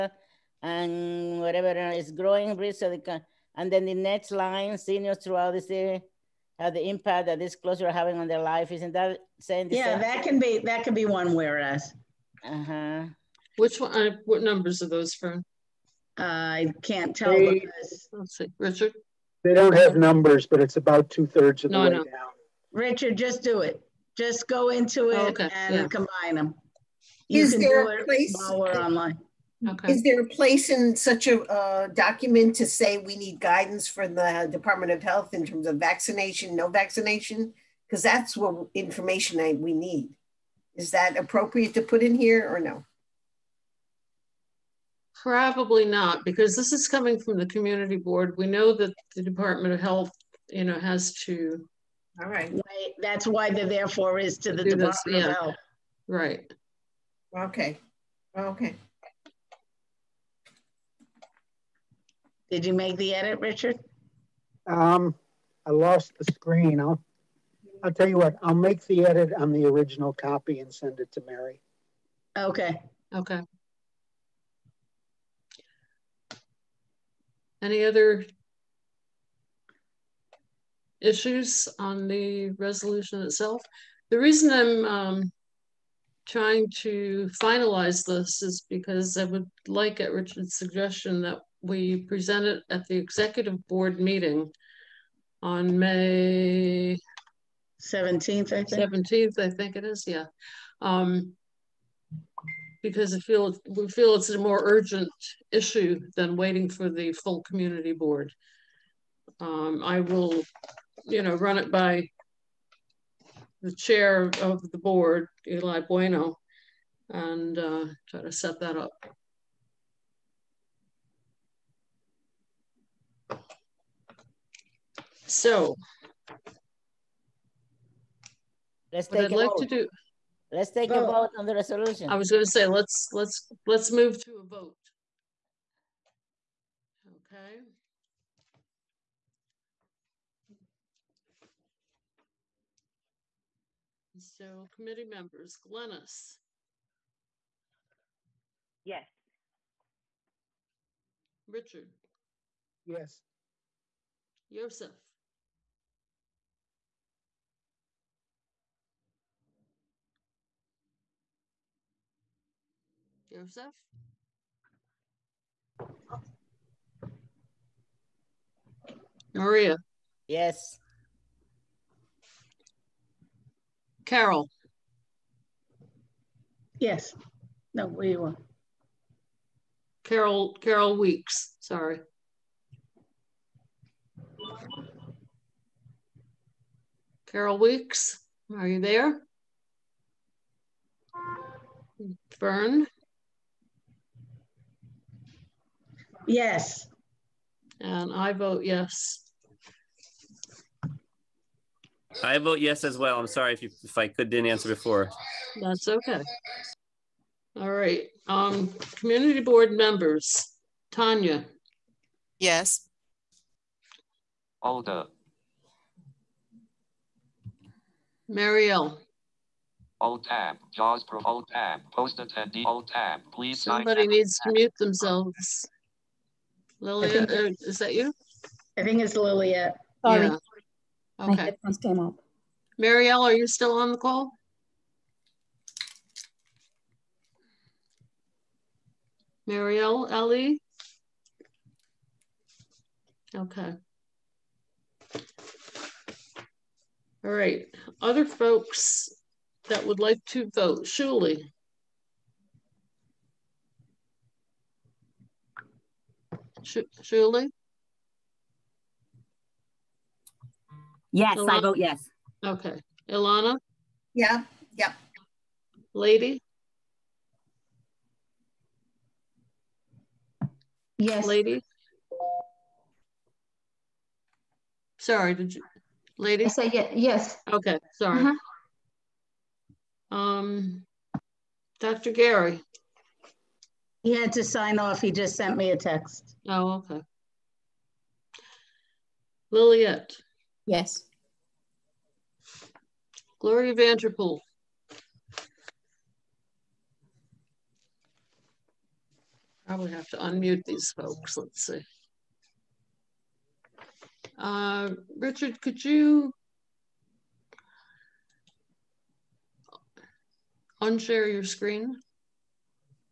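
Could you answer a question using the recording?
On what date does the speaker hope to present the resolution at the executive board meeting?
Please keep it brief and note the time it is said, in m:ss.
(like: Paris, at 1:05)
May 17, at 1:35.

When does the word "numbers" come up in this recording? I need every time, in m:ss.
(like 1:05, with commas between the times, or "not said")
0:14, 0:19.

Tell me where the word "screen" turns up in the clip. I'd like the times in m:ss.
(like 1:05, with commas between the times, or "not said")
1:06, 5:11.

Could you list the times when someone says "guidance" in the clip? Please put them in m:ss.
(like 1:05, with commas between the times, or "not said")
0:33.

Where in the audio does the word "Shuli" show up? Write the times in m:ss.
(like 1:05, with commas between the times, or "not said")
4:10, 4:17.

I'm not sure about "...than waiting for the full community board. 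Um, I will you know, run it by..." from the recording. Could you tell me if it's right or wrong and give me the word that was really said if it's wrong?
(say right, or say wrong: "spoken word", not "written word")
right.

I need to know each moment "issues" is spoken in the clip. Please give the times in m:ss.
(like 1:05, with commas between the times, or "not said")
1:21, 1:45.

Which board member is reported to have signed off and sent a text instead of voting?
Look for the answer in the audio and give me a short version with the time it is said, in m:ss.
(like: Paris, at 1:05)
Dr. Gary, at 4:41.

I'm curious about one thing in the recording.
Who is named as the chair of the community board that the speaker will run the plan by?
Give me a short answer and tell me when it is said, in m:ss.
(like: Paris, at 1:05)
Eli Bueno, at 1:55.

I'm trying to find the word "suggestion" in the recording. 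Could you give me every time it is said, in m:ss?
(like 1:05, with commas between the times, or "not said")
1:30.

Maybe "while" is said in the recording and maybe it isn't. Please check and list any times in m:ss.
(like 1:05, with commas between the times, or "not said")
0:28.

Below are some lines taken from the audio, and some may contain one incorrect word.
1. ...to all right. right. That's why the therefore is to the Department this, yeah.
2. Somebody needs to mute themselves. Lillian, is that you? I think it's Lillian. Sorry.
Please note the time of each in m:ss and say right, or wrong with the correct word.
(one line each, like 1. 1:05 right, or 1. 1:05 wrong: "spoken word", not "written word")
1. 0:51 right
2. 3:43 right.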